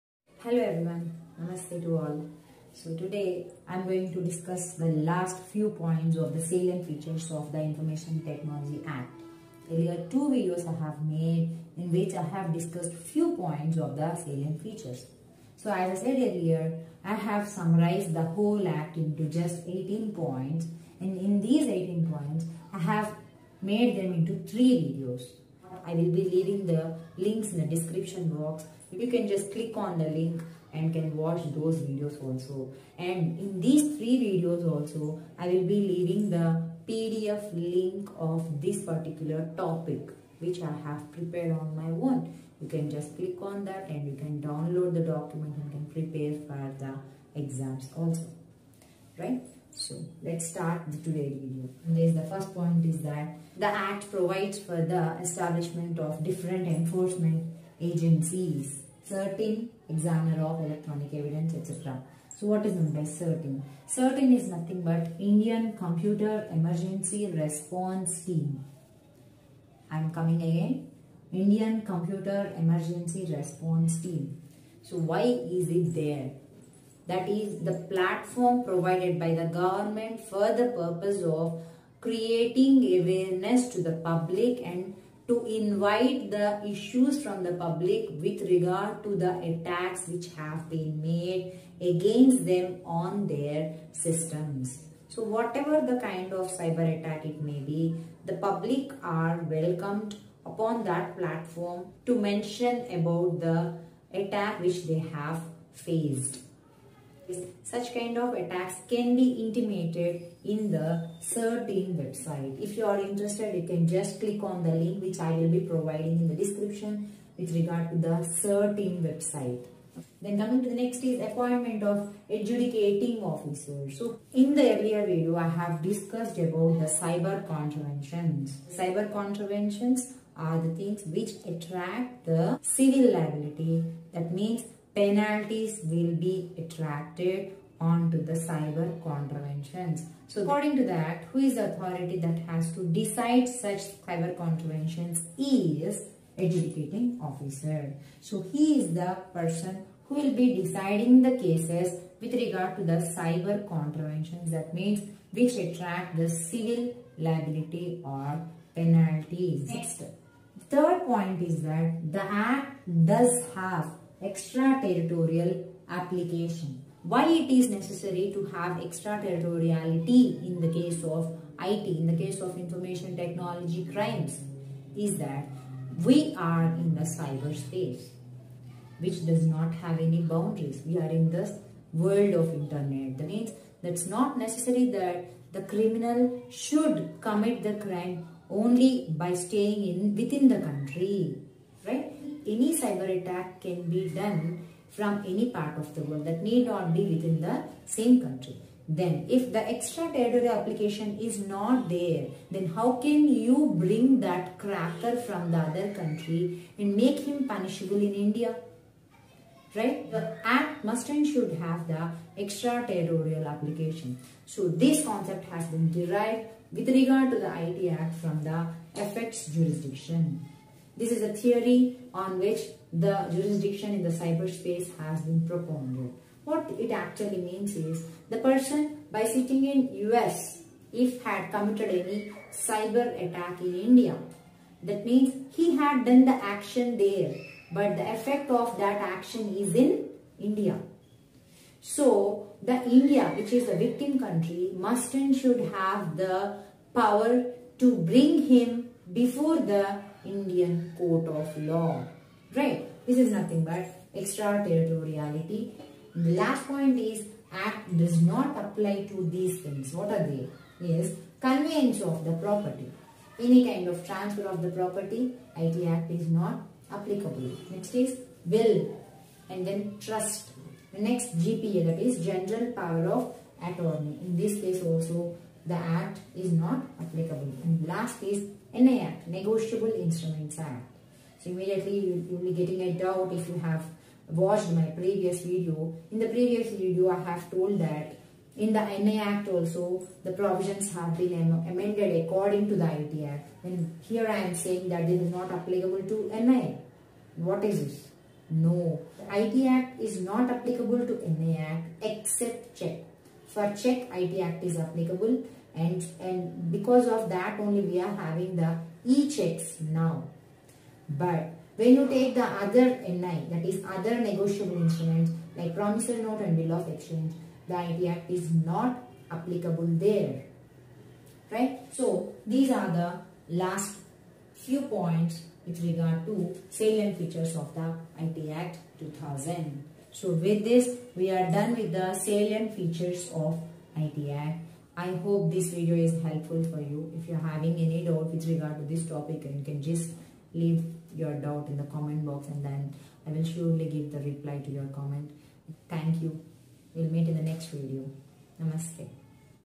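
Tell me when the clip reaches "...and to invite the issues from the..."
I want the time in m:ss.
1:24.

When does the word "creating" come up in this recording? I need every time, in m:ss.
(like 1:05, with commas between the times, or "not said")
1:21.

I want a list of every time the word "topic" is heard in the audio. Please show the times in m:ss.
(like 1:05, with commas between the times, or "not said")
0:39, 5:39.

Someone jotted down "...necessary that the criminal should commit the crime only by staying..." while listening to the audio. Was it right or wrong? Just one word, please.
right.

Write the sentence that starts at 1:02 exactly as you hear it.
So what is meant by CERT-In?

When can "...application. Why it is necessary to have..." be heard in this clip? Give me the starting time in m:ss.
2:45.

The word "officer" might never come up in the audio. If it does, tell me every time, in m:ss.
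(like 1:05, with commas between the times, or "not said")
2:03, 2:27.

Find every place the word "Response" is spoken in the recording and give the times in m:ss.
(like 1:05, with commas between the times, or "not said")
1:07, 1:13.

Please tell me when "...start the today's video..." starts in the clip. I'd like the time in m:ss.
0:50.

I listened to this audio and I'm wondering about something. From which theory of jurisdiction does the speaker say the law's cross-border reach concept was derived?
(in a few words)
Effects jurisdiction.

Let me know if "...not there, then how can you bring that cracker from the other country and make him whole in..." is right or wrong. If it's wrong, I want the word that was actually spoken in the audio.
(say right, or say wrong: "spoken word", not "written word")
wrong: "punishable", not "whole".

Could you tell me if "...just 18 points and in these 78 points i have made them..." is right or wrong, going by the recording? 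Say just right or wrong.
wrong.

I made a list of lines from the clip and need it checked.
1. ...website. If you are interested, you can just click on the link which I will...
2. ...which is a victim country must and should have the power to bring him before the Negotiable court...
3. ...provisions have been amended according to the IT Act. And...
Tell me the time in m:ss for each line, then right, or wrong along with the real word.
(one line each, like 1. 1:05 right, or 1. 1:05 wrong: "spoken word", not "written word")
1. 1:51 right
2. 4:03 wrong: "Indian", not "Negotiable"
3. 4:50 right.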